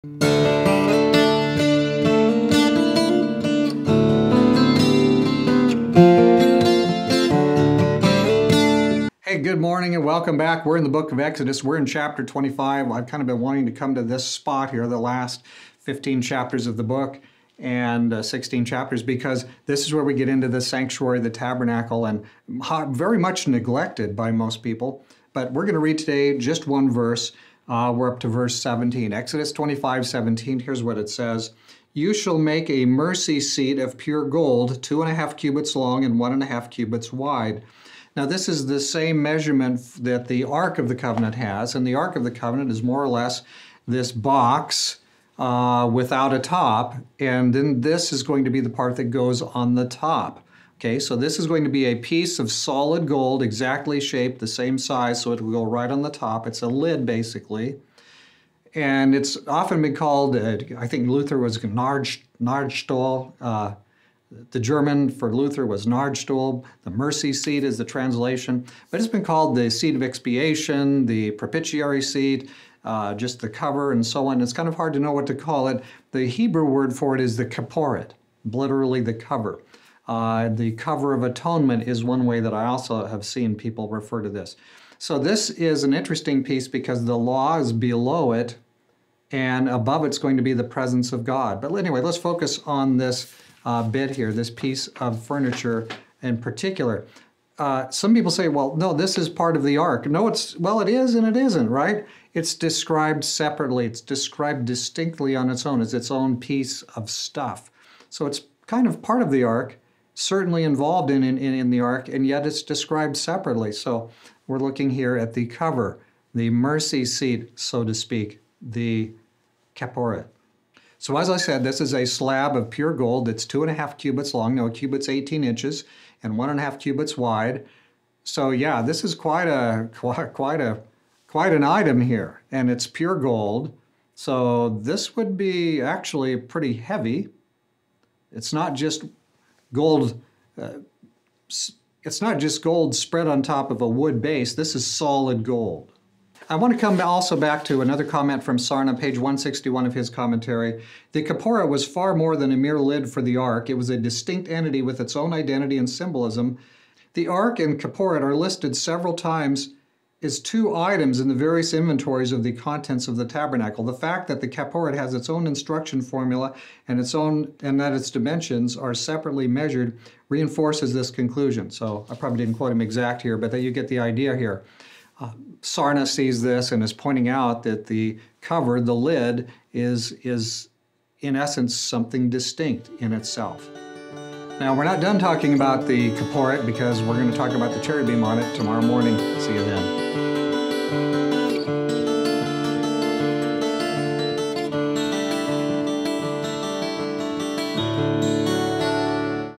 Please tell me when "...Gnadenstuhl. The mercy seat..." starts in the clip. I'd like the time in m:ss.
1:05.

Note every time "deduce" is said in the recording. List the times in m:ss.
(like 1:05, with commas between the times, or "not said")
not said.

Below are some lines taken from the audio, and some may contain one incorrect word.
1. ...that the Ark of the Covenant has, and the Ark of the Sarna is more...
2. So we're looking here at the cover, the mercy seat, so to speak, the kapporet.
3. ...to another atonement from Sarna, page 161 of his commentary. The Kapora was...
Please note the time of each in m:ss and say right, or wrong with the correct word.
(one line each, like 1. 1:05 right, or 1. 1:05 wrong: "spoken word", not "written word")
1. 0:40 wrong: "Covenant", not "Sarna"
2. 1:53 right
3. 2:27 wrong: "comment", not "atonement".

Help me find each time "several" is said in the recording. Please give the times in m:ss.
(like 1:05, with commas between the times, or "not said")
2:38.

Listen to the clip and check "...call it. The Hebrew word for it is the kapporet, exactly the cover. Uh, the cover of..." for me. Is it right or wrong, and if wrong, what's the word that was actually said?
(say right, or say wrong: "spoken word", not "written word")
wrong: "literally", not "exactly".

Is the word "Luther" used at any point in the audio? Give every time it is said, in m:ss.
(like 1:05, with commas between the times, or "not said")
1:01, 1:05.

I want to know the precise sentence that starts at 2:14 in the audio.
So this would be actually pretty heavy.